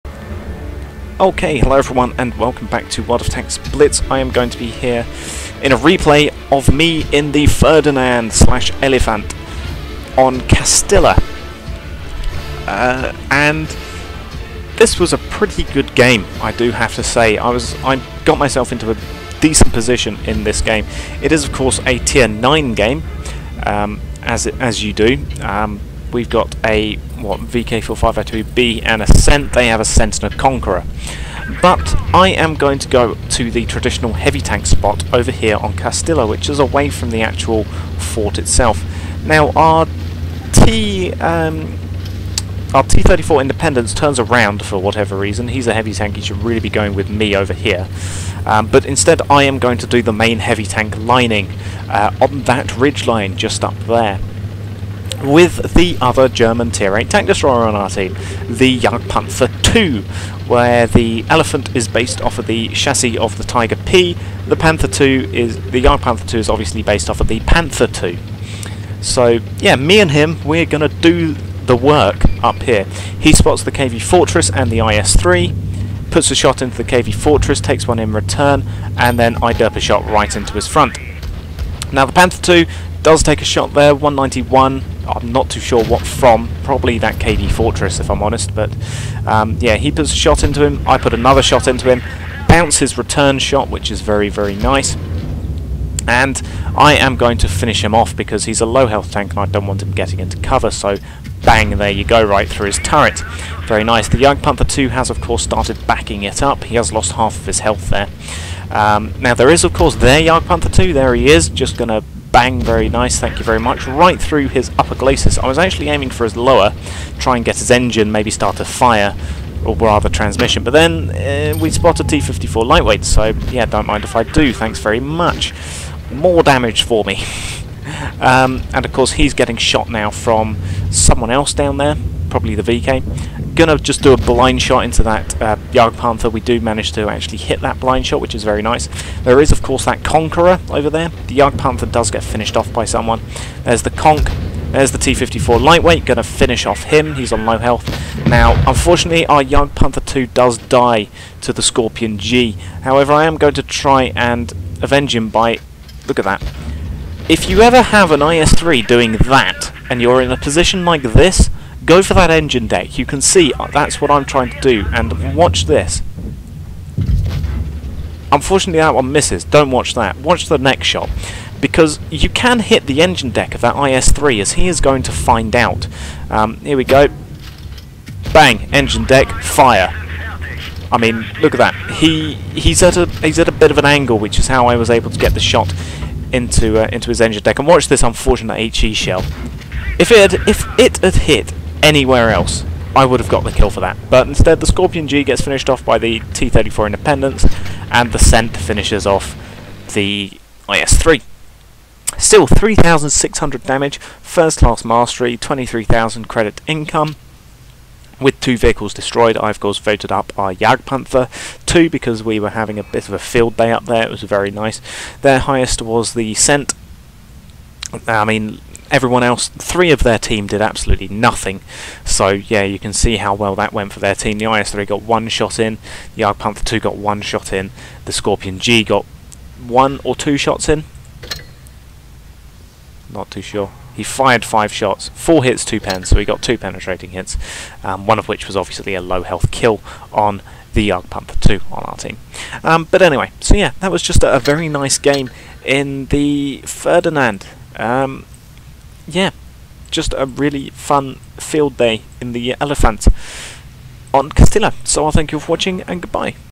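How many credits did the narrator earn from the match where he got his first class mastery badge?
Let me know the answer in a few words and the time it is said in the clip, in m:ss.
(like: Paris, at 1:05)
23,000, at 3:25.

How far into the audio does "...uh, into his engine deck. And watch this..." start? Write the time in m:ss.
3:06.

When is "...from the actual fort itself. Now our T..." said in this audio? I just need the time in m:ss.
0:36.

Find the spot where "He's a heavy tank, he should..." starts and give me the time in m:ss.
0:45.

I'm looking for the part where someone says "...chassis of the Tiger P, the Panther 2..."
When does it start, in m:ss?
1:02.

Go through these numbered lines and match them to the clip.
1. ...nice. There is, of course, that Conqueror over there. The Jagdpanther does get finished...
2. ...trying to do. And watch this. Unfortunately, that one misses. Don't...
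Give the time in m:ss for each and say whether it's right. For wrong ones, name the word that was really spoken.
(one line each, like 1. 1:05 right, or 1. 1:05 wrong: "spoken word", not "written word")
1. 2:18 right
2. 2:44 right.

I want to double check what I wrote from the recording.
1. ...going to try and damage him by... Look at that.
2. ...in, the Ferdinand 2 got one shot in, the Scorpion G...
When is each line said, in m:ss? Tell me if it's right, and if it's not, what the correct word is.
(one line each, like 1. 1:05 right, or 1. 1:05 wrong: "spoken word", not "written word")
1. 2:33 wrong: "avenge", not "damage"
2. 3:45 wrong: "Jagdpanther", not "Ferdinand".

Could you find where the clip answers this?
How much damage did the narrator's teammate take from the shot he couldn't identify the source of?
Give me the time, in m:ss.
1:23.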